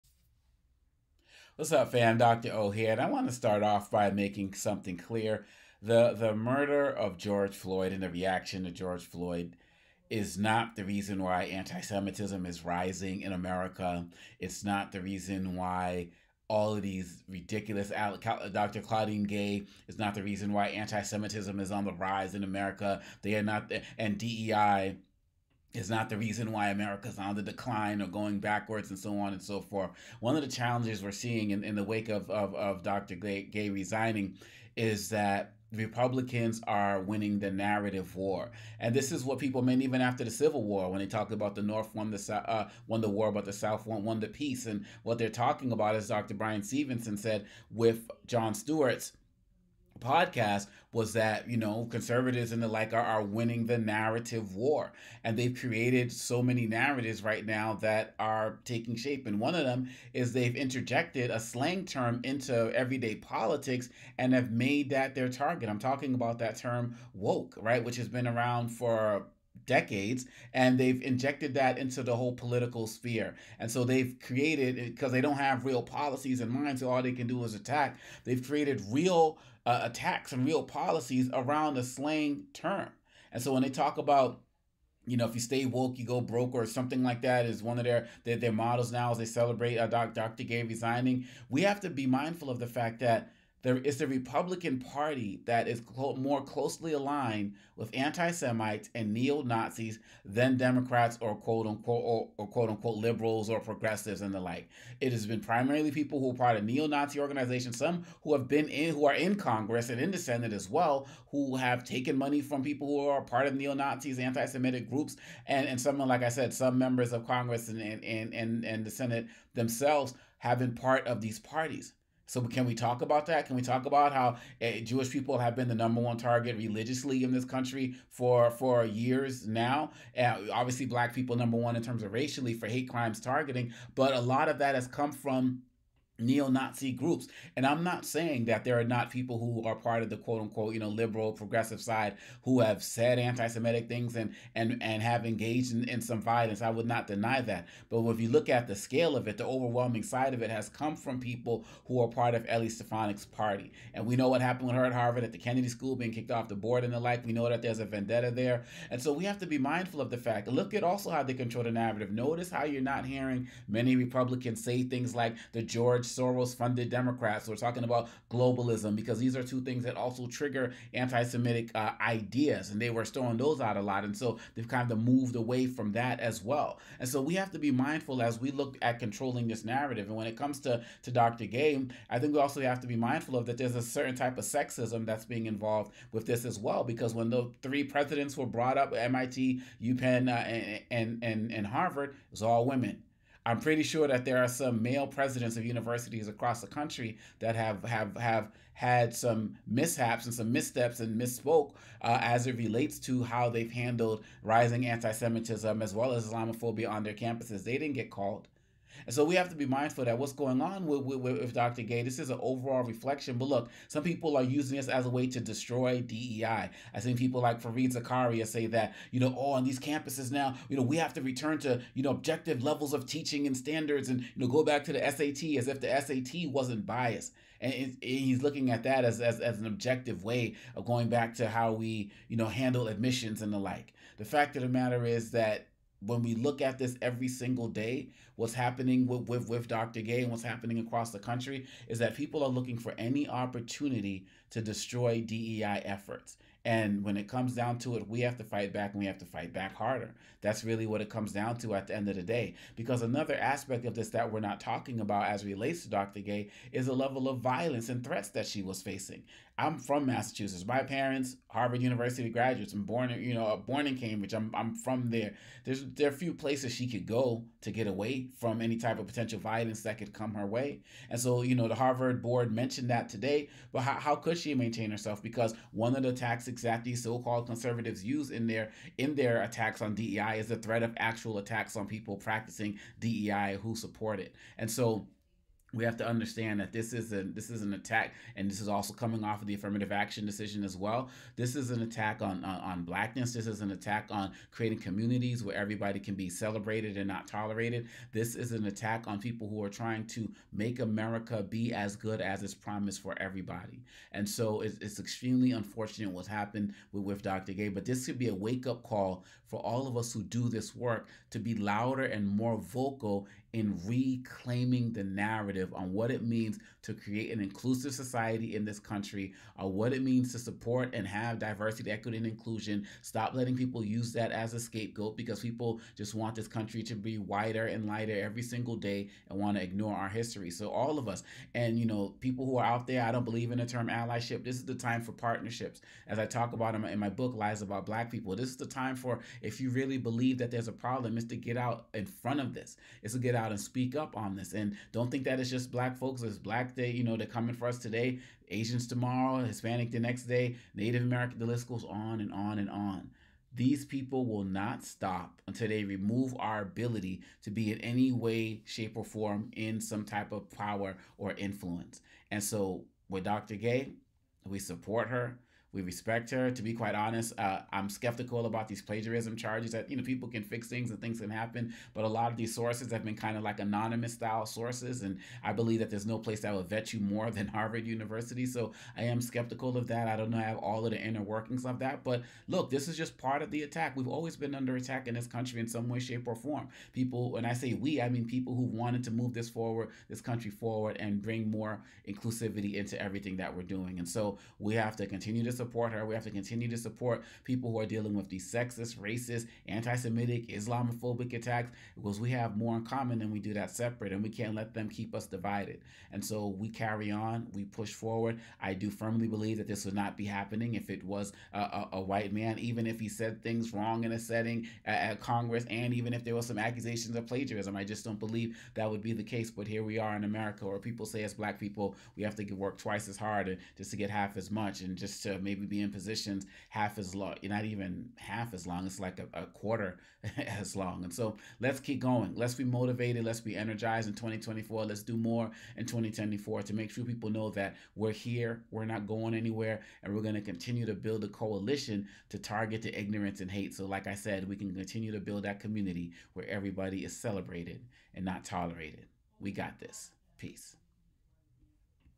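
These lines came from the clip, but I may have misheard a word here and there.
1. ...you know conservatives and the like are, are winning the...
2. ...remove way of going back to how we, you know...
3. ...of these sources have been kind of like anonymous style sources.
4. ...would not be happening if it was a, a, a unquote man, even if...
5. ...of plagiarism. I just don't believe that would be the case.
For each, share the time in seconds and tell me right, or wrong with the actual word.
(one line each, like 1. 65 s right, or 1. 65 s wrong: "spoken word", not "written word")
1. 51 s right
2. 229 s wrong: "objective", not "remove"
3. 372 s right
4. 409 s wrong: "white", not "unquote"
5. 417 s right.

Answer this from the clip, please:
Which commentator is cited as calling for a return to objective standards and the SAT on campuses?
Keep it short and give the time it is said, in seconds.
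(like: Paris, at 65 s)
Fareed Zakaria, at 217 s.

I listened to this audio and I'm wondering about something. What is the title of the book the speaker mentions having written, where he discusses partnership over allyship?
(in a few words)
Lies About Black People.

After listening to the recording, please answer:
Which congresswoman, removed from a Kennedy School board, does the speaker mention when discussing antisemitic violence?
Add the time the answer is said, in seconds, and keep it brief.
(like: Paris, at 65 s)
Elise Stefanik, at 152 s.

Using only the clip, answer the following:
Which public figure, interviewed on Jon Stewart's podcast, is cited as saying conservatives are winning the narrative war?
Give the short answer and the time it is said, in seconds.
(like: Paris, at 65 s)
Bryan Stevenson, at 46 s.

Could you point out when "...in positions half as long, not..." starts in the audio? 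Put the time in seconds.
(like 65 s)
425 s.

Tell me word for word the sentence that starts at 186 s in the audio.
Because when the three presidents were brought up MIT, UPenn, uh, and, and, and, and Harvard, it was all women.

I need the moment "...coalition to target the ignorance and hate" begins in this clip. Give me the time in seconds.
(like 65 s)
441 s.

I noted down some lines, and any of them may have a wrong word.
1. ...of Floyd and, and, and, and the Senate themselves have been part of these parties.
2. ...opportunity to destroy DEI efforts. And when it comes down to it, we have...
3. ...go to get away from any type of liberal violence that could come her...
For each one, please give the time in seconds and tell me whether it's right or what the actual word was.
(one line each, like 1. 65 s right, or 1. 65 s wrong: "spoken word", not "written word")
1. 117 s wrong: "Congress", not "Floyd"
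2. 243 s right
3. 267 s wrong: "potential", not "liberal".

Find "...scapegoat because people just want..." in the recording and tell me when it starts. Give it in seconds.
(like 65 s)
324 s.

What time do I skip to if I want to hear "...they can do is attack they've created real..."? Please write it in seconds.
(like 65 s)
77 s.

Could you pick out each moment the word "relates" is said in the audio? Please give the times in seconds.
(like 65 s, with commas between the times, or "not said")
202 s, 255 s.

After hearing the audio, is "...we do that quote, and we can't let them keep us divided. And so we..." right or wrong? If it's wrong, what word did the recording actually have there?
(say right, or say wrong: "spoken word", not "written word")
wrong: "separate", not "quote".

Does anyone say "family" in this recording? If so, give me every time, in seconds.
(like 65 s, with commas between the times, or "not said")
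not said.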